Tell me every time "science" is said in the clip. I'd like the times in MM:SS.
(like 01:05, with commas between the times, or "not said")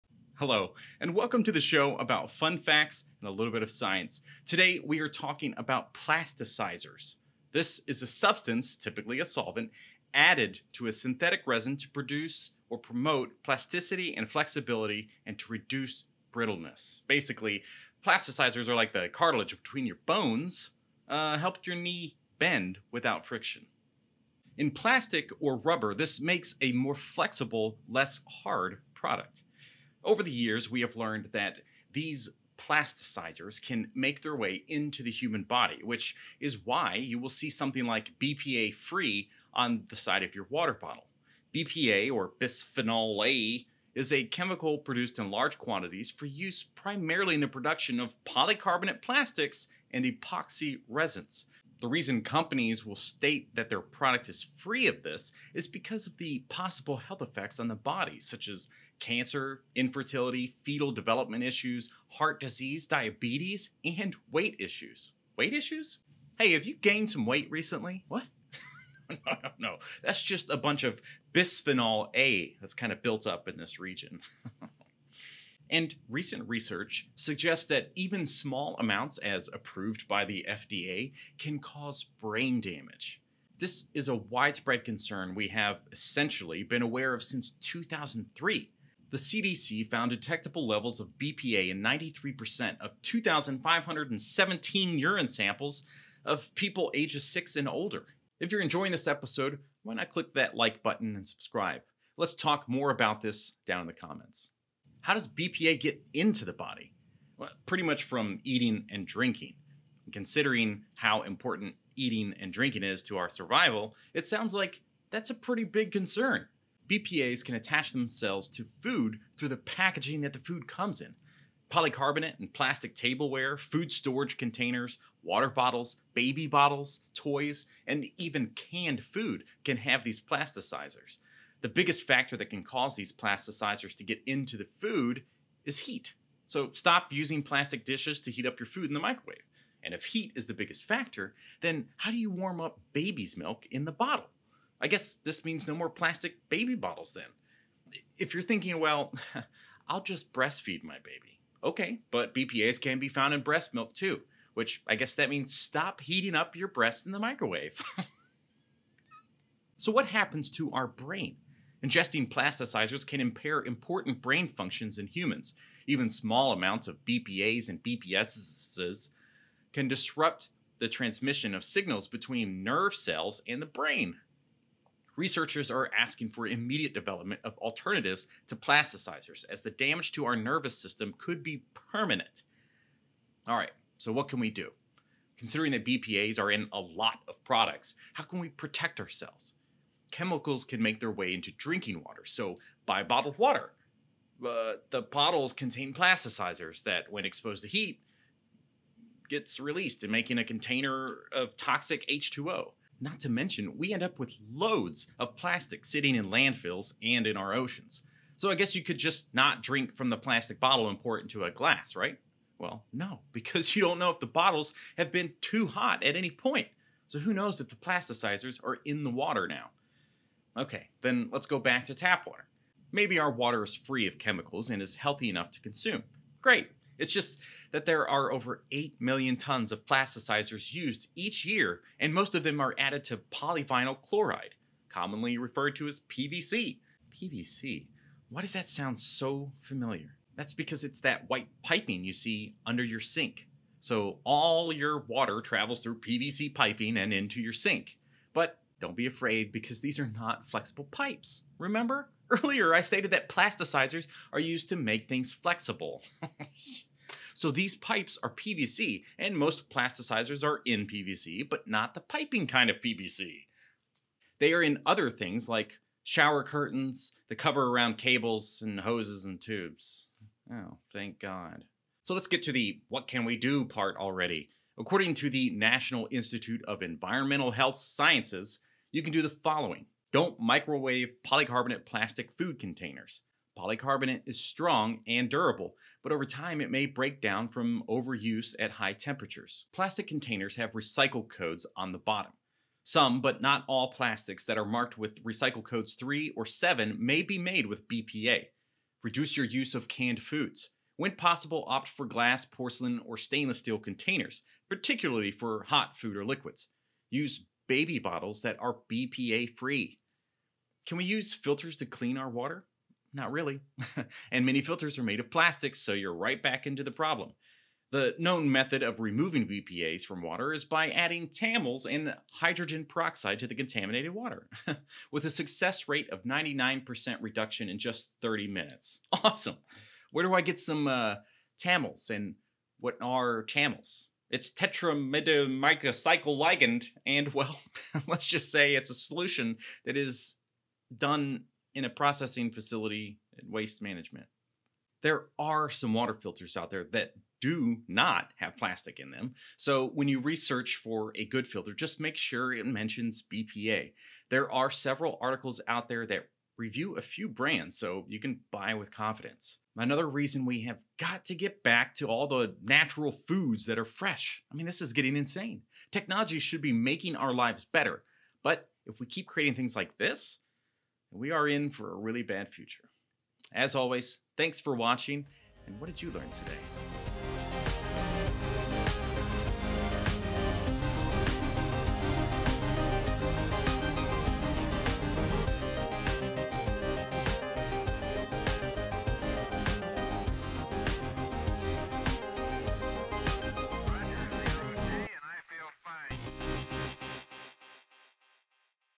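00:03, 04:37.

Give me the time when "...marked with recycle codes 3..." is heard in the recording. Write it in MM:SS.
04:54.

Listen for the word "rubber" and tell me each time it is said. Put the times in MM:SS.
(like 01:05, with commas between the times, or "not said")
00:25.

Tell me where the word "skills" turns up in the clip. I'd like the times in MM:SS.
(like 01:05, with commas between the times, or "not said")
not said.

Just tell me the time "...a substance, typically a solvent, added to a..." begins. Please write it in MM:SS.
00:08.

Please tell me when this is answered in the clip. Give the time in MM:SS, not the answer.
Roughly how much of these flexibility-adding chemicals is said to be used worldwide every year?
03:48.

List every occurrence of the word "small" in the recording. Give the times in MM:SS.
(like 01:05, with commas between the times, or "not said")
01:18, 02:46.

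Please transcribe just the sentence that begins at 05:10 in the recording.
Can we use filters to clean our water?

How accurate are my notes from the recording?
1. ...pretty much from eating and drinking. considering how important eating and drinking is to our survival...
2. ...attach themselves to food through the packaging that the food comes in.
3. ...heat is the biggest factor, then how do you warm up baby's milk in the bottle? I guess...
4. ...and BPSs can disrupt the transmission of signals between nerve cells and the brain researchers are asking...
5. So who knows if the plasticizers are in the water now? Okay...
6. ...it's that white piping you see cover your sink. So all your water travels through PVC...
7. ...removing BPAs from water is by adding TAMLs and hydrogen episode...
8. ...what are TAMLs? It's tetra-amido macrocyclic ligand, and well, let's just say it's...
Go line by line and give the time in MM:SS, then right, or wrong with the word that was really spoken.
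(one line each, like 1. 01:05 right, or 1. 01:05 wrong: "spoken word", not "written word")
1. 01:47 right
2. 01:57 right
3. 02:20 right
4. 02:47 right
5. 03:37 right
6. 04:00 wrong: "under", not "cover"
7. 05:19 wrong: "peroxide", not "episode"
8. 05:32 right.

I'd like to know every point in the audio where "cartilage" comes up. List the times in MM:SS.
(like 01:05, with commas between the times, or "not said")
00:19.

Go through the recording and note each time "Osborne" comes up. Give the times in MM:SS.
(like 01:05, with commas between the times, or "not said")
not said.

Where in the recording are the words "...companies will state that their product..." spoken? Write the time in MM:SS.
00:52.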